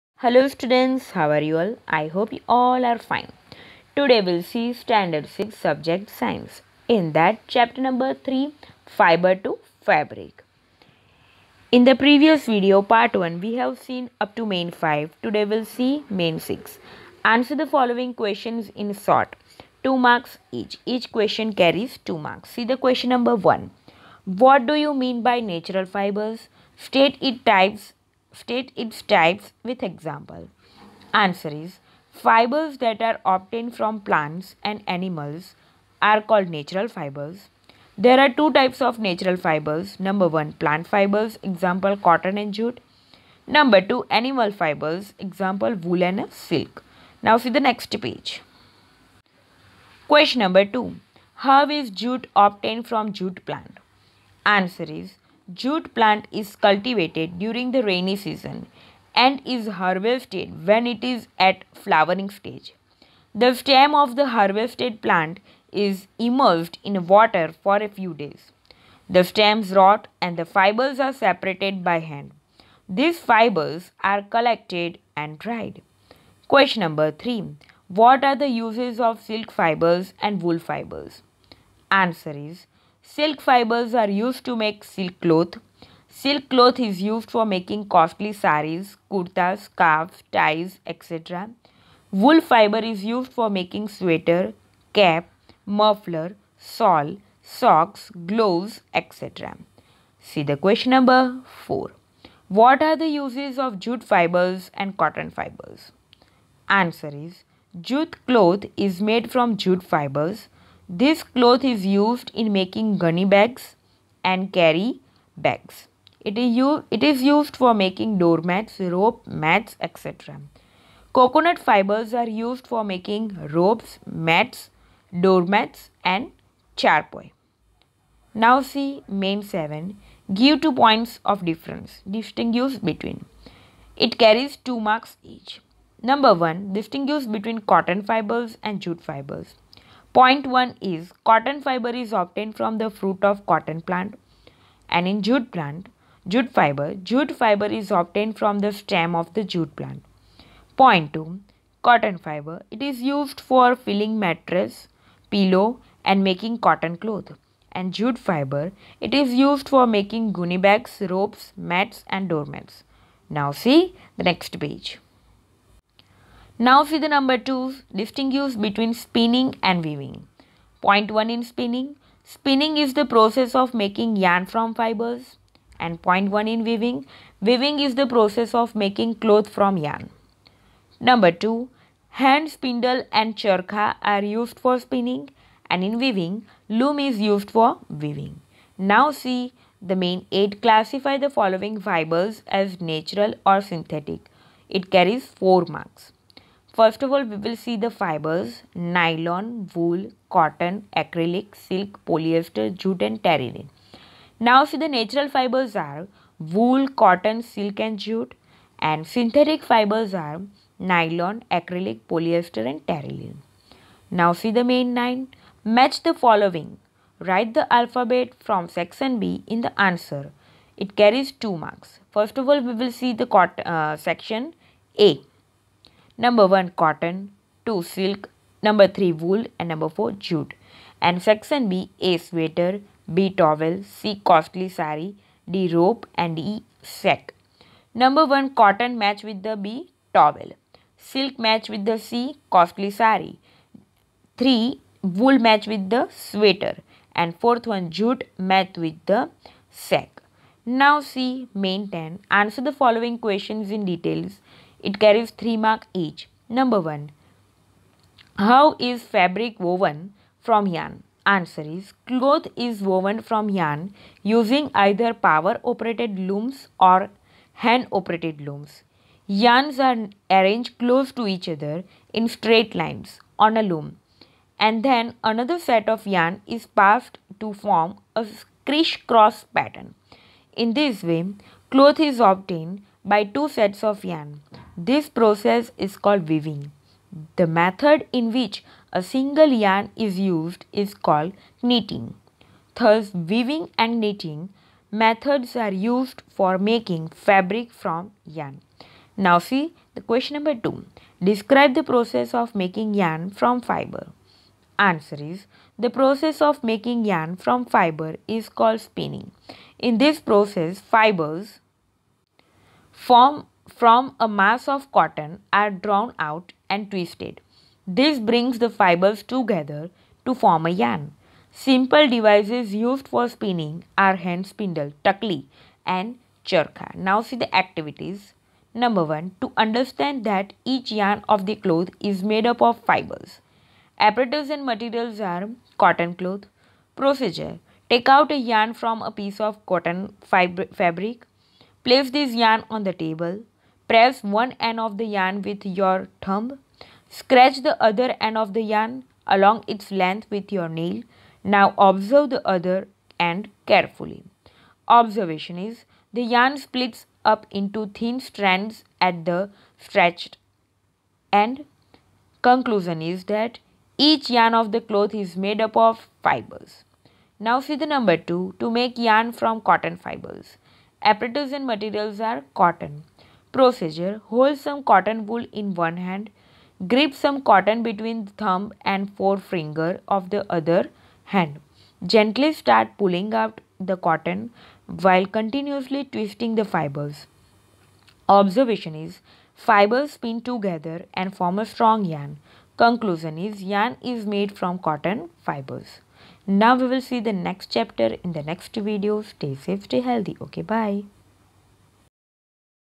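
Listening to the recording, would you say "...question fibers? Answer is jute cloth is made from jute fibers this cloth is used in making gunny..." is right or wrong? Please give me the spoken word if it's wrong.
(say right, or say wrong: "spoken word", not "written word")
wrong: "cotton", not "question".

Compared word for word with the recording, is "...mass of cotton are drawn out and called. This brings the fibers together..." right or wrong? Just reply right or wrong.
wrong.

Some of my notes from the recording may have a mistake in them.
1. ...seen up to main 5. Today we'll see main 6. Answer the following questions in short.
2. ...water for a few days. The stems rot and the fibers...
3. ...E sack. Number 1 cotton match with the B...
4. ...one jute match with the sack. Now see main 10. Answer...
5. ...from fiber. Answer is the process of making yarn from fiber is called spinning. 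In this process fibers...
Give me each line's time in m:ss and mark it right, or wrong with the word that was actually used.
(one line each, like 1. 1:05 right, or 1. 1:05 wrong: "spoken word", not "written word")
1. 0:13 right
2. 1:07 right
3. 3:56 right
4. 4:07 right
5. 5:03 right.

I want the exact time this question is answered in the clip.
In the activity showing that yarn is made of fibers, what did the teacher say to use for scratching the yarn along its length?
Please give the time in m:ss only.
5:50.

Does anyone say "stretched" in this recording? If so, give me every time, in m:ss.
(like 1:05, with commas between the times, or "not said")
5:59.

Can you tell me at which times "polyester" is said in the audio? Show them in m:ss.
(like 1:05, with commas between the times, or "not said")
3:22, 3:32.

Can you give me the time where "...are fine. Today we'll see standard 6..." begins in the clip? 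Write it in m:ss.
0:02.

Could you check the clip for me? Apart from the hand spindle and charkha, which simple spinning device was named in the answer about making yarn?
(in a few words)
Tukli.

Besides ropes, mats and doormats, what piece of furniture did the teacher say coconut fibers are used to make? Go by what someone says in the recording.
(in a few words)
Charpoy.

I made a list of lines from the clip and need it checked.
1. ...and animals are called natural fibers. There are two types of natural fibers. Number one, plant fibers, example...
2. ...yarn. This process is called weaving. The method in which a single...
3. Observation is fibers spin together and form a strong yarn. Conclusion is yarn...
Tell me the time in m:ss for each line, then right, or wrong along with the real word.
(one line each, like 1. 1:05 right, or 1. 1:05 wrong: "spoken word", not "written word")
1. 0:34 right
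2. 4:44 right
3. 6:28 right.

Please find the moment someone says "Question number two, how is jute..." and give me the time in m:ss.
0:50.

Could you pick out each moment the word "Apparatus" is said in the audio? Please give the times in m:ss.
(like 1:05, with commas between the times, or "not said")
5:34, 6:11.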